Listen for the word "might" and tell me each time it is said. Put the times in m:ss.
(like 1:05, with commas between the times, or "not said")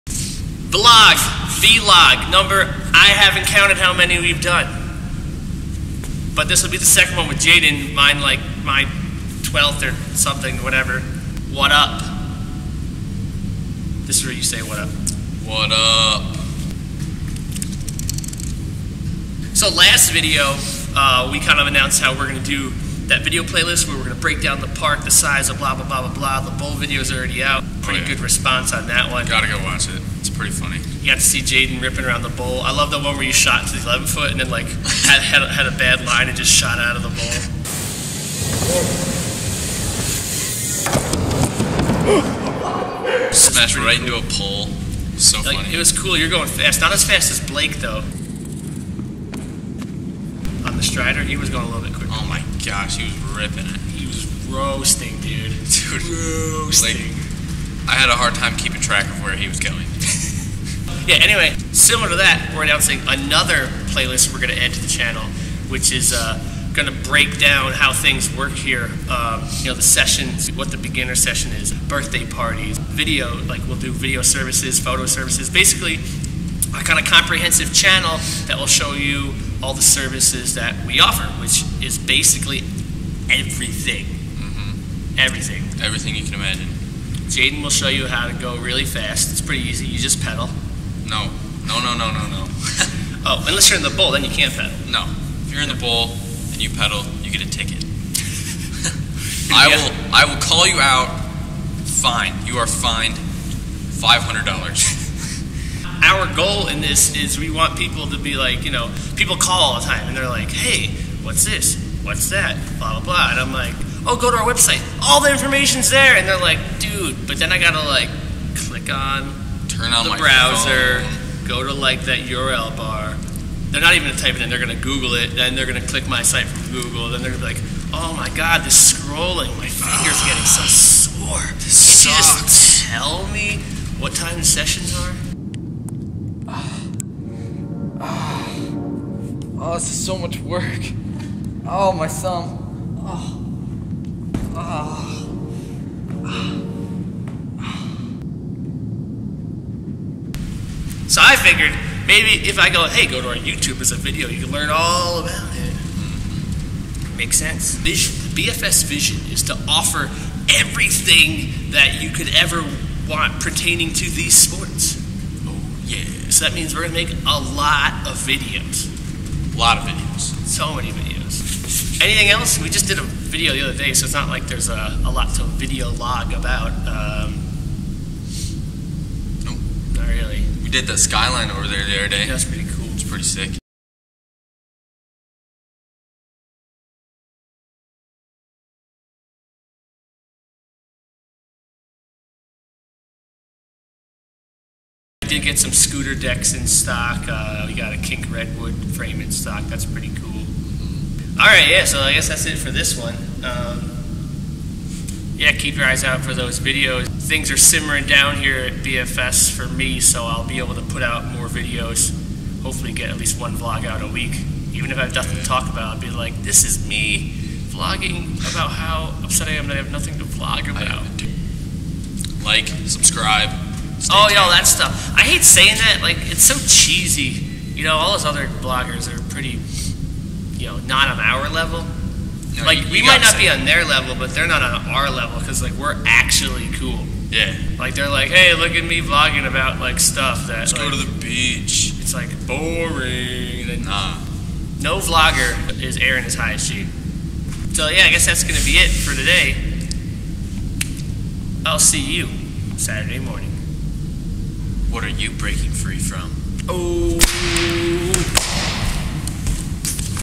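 3:53.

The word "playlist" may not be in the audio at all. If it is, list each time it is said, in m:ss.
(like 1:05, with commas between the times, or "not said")
0:23, 1:03.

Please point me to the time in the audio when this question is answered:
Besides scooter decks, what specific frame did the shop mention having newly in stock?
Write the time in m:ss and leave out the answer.
3:17.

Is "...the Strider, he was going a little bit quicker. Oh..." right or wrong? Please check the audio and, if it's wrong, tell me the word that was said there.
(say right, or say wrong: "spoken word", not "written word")
right.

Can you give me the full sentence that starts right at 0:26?
The bowl video is already out.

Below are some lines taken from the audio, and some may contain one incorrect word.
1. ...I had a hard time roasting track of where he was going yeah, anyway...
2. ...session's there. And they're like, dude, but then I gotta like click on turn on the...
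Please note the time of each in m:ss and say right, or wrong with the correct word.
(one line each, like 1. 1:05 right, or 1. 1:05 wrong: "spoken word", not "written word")
1. 0:57 wrong: "keeping", not "roasting"
2. 1:55 wrong: "information", not "session".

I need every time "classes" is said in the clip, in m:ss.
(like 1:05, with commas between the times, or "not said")
not said.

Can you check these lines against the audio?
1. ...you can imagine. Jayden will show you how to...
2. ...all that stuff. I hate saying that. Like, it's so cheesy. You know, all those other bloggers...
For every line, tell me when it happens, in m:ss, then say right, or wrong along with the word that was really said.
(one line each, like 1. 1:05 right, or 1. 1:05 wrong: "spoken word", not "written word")
1. 1:26 right
2. 3:44 right.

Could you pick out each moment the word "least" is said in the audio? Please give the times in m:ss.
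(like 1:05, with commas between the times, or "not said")
3:33.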